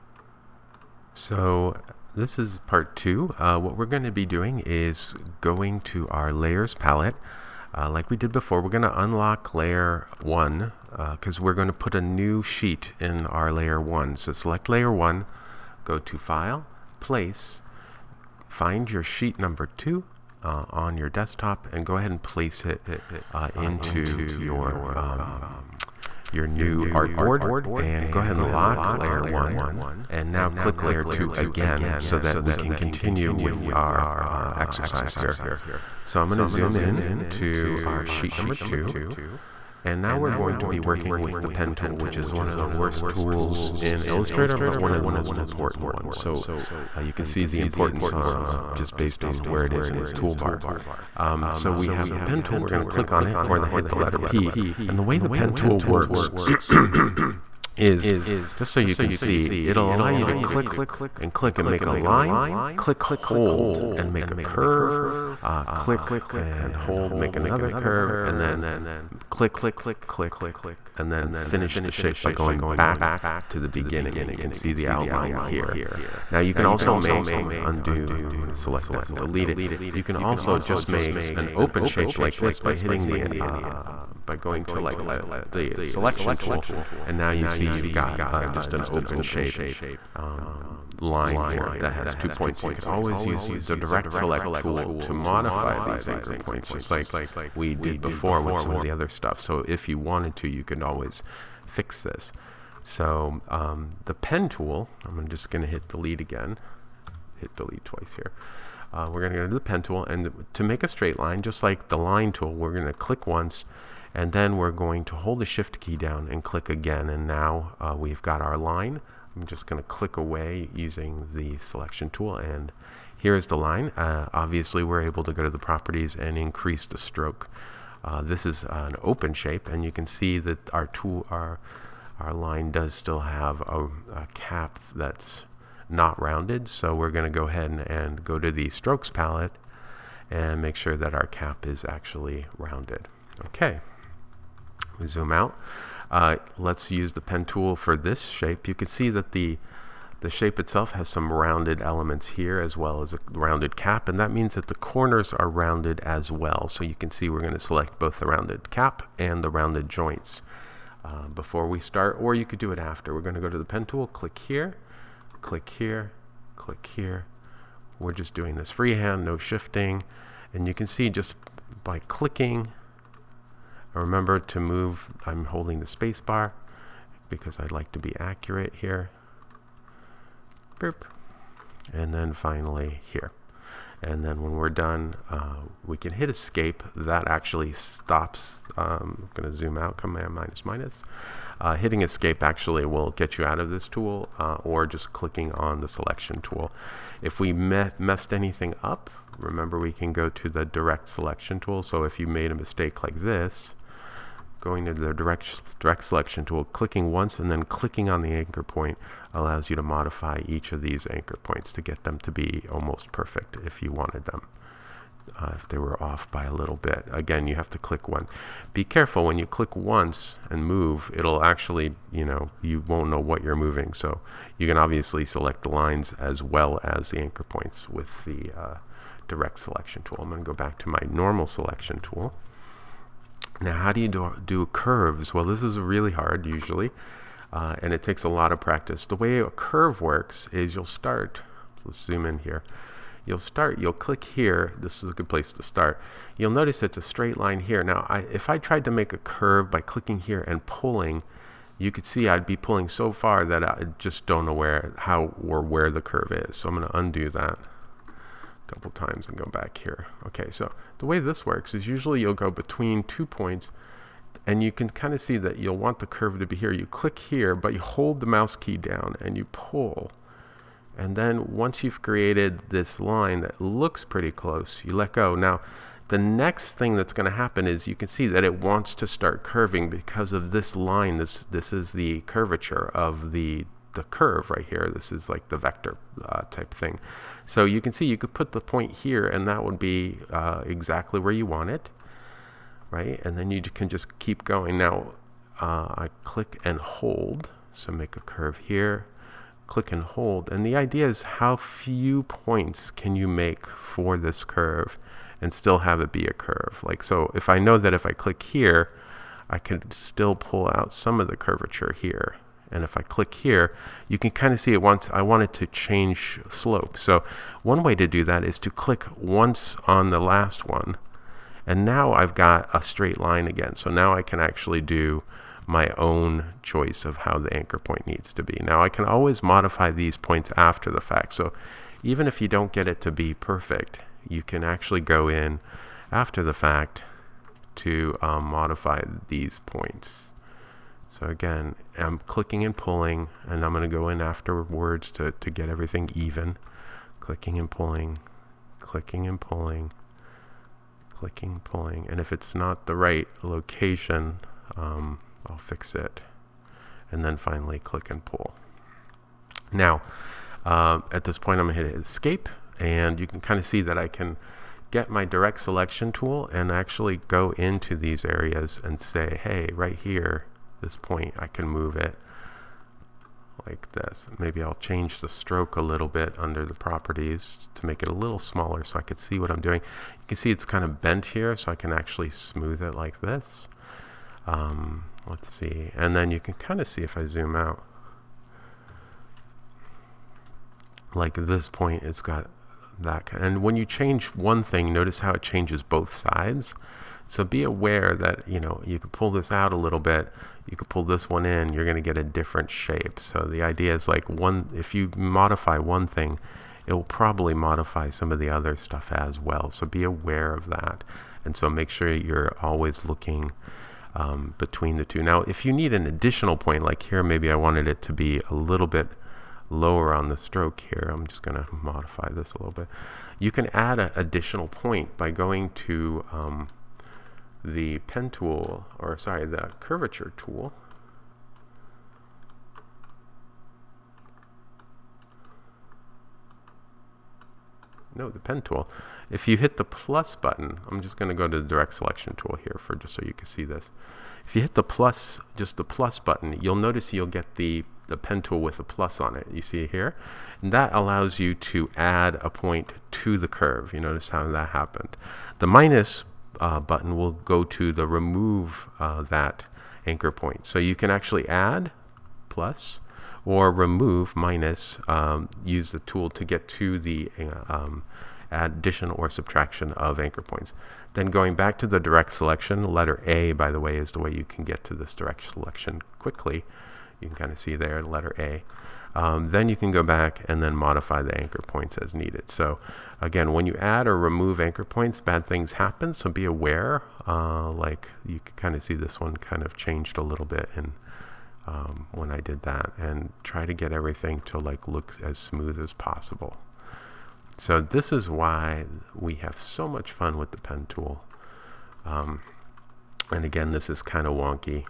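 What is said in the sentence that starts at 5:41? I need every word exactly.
So again, I'm clicking and pulling, and I'm going to go in afterwards to, to get everything even.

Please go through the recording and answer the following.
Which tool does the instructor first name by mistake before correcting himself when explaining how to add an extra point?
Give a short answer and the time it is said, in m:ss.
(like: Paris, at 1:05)
Curvature tool, at 7:09.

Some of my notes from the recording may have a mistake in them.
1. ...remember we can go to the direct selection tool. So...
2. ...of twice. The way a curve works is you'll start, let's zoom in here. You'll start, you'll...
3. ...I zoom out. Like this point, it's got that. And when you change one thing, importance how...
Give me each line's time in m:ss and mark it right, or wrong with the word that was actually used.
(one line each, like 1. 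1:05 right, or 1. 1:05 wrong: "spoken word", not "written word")
1. 3:19 right
2. 3:58 wrong: "practice", not "twice"
3. 6:27 wrong: "notice", not "importance".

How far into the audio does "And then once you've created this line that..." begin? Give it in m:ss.
4:30.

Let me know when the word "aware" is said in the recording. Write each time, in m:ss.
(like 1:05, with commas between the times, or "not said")
6:37, 6:50, 8:06.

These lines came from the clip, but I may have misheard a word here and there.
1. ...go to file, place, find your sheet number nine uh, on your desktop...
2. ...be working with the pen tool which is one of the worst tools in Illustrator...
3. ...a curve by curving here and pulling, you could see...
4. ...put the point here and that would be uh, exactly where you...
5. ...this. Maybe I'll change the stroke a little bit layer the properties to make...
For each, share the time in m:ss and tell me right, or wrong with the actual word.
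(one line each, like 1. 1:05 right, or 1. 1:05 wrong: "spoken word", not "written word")
1. 0:15 wrong: "two", not "nine"
2. 0:40 right
3. 4:09 wrong: "clicking", not "curving"
4. 4:48 right
5. 6:13 wrong: "under", not "layer".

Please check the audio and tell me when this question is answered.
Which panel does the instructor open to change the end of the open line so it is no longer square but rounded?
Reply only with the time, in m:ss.
2:18.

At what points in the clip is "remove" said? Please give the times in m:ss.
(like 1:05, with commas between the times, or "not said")
7:38, 7:43, 8:04.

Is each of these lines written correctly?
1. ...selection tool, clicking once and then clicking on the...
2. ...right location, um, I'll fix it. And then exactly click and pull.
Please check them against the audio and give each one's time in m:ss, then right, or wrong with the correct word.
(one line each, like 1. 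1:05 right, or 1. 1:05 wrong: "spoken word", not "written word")
1. 3:26 right
2. 5:52 wrong: "finally", not "exactly".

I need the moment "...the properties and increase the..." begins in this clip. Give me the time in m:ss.
2:05.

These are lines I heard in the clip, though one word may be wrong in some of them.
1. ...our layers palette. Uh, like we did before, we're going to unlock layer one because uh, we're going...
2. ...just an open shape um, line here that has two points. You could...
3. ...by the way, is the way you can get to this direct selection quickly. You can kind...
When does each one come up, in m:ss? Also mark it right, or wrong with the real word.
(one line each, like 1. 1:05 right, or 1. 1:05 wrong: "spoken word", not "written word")
1. 0:06 right
2. 1:28 right
3. 7:53 right.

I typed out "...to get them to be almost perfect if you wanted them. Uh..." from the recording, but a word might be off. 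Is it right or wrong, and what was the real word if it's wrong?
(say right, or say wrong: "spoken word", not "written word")
right.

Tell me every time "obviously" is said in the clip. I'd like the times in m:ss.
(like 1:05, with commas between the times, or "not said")
2:04, 3:44.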